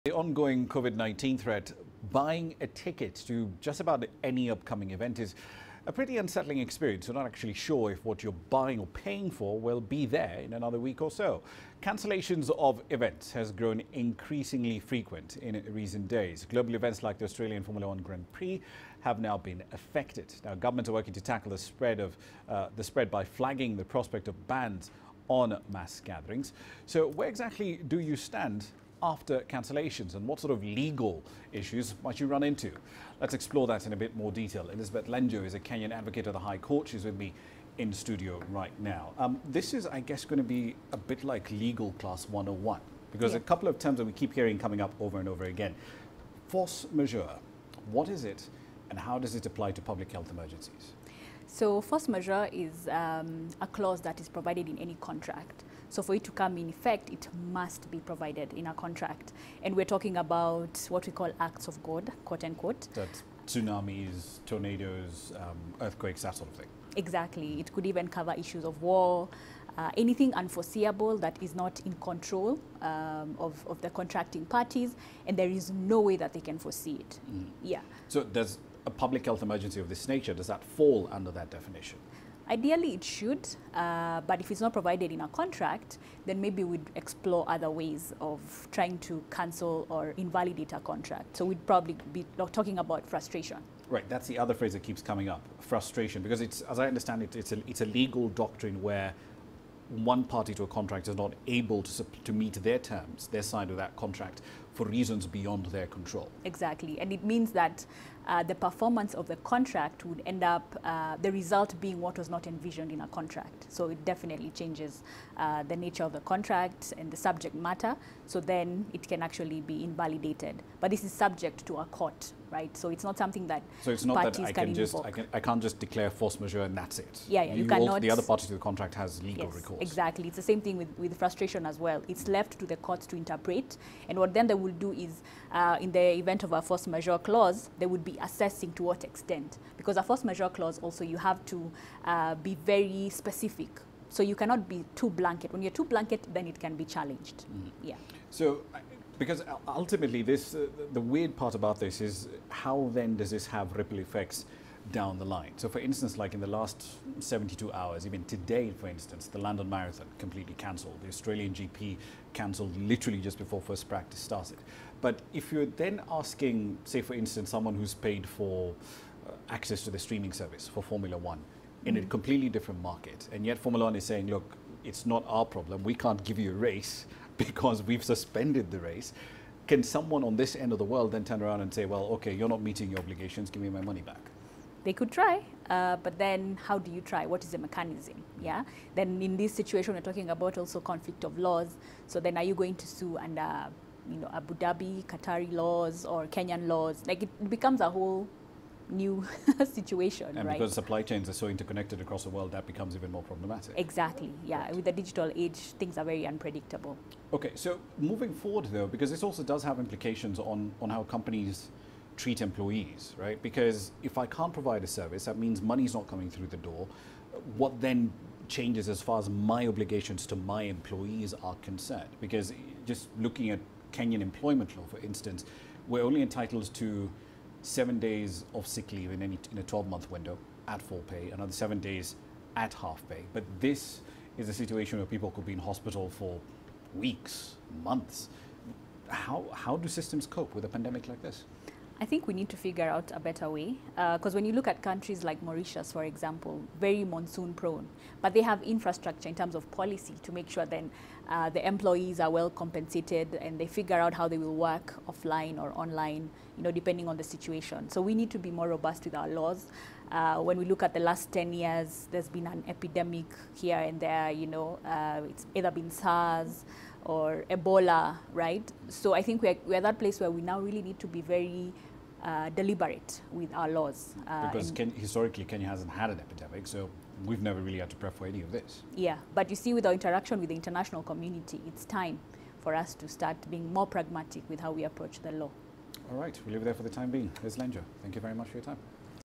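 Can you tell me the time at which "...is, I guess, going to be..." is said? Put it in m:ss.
0:39.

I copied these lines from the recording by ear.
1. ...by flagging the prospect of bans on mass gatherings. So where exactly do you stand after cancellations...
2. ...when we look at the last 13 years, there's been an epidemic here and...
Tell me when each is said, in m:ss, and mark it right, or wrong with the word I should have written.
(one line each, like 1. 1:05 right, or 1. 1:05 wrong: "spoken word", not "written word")
1. 0:23 right
2. 4:20 wrong: "10", not "13".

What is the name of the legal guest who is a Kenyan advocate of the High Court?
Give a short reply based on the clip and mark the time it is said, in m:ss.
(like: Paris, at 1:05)
Elizabeth Lenjo, at 0:34.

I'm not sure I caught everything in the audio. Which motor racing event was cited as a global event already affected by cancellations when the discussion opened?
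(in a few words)
Australian Formula One Grand Prix.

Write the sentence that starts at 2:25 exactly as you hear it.
When you're too blanket, then it can be challenged.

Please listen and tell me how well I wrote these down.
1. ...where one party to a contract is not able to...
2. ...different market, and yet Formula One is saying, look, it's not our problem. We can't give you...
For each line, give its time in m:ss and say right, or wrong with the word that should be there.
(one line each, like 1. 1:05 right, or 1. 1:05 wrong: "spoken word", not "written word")
1. 1:38 right
2. 2:52 right.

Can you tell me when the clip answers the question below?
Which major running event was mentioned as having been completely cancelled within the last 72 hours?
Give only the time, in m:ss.
2:39.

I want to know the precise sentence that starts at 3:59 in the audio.
How, how do systems cope with a pandemic like this?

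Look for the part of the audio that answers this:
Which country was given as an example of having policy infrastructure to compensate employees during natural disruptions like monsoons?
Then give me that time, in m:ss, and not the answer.
4:05.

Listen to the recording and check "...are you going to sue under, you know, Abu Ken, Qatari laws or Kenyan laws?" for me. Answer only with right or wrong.
wrong.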